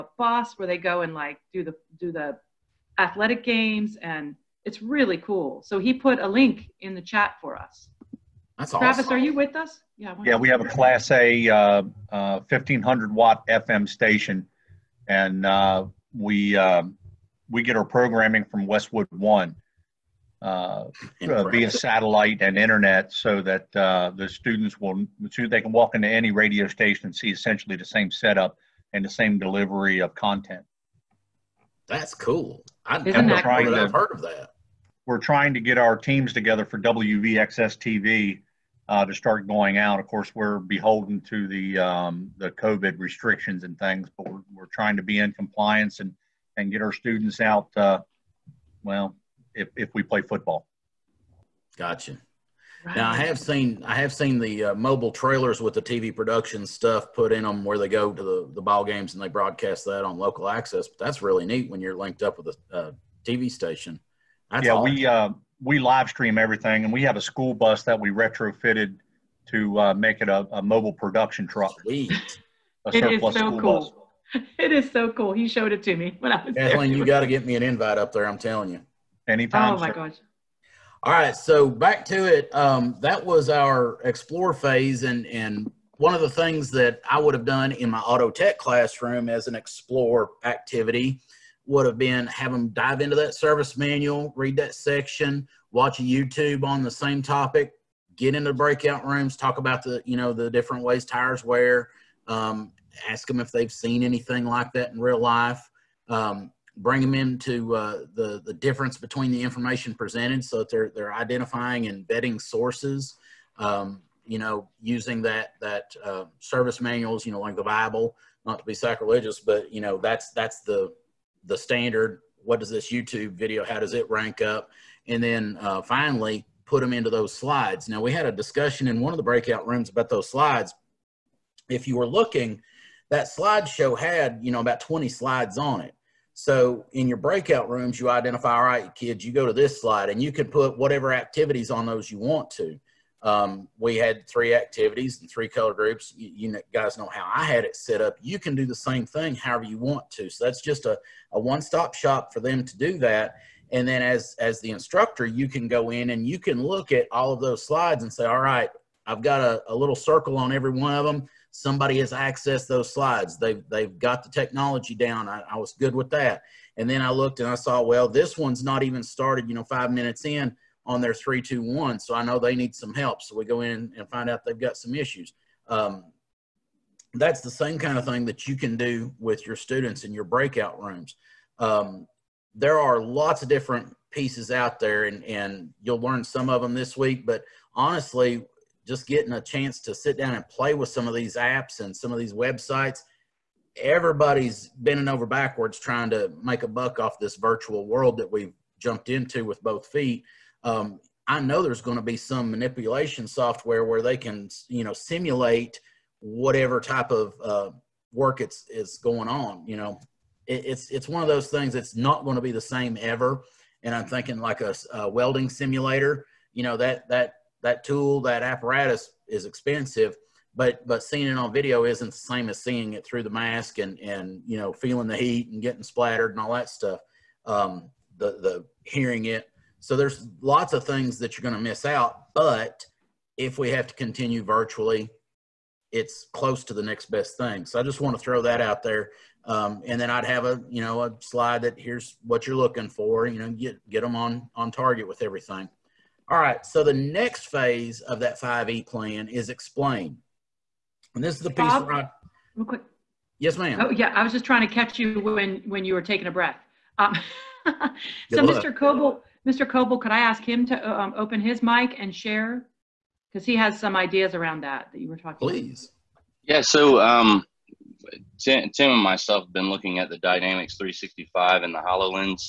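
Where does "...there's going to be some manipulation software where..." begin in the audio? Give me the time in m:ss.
3:21.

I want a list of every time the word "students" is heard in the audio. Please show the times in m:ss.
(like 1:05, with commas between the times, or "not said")
0:24, 0:46, 2:59.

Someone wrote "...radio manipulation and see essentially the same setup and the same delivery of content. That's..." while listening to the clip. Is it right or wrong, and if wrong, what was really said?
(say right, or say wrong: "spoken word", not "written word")
wrong: "station", not "manipulation".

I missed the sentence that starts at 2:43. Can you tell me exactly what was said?
They've, they've got the technology down.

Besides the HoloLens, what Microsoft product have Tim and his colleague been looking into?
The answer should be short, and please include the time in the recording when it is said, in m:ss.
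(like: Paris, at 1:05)
Dynamics 365, at 4:30.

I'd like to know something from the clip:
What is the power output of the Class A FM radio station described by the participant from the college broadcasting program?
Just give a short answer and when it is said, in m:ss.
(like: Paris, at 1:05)
1500 watts, at 0:12.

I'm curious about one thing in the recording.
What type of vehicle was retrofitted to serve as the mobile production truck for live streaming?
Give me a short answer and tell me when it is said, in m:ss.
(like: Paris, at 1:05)
school bus, at 1:07.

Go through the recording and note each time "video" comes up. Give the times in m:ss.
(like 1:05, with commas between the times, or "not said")
2:03, 3:41.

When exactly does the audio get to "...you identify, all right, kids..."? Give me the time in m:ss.
2:17.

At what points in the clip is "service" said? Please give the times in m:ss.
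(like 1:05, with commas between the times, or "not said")
1:33, 1:56.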